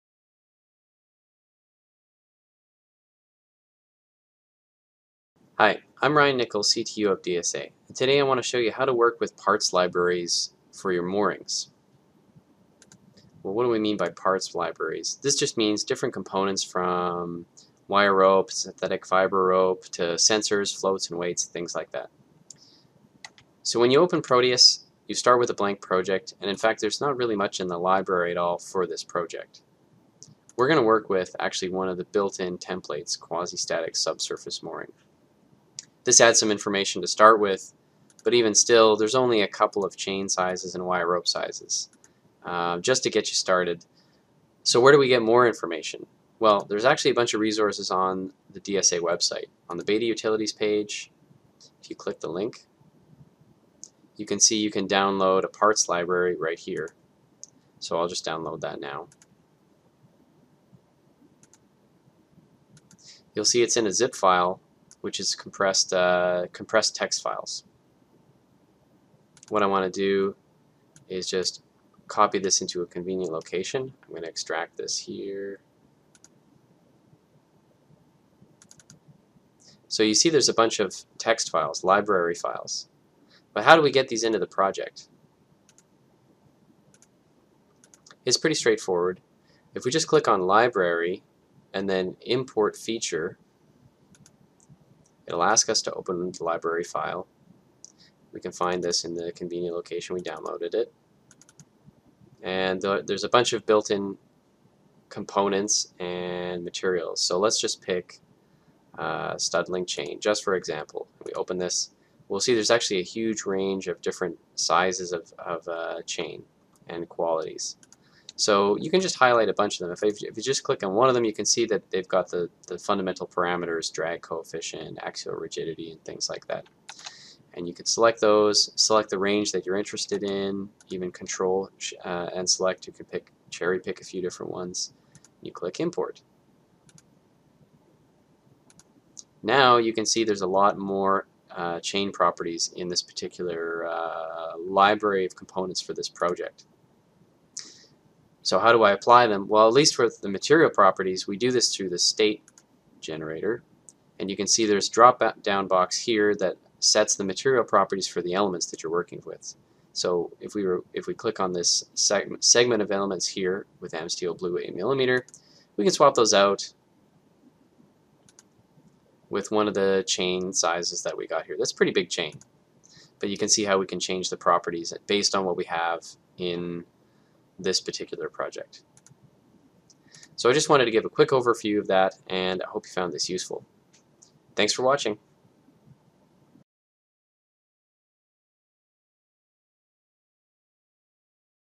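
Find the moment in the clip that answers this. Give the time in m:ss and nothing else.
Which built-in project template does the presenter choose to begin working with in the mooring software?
0:33.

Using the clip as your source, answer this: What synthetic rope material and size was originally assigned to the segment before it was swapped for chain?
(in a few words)
Amsteel Blue 8 mm.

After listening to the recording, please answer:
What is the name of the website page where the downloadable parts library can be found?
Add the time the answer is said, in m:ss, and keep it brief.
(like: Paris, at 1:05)
Beta Utilities, at 0:49.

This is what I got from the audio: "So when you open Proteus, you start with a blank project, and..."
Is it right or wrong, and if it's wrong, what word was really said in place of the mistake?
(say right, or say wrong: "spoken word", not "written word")
right.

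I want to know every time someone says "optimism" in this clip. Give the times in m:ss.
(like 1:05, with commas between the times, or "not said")
not said.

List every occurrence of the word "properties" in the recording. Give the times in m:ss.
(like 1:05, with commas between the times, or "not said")
2:22, 2:30, 2:37, 2:54.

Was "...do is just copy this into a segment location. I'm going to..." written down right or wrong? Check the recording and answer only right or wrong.
wrong.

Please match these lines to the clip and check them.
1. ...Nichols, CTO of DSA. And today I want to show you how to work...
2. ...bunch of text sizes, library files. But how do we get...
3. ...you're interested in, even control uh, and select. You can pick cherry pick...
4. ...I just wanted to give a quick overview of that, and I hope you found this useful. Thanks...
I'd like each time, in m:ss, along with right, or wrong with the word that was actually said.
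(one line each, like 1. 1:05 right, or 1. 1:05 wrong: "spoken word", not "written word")
1. 0:06 right
2. 1:20 wrong: "files", not "sizes"
3. 2:09 right
4. 3:00 right.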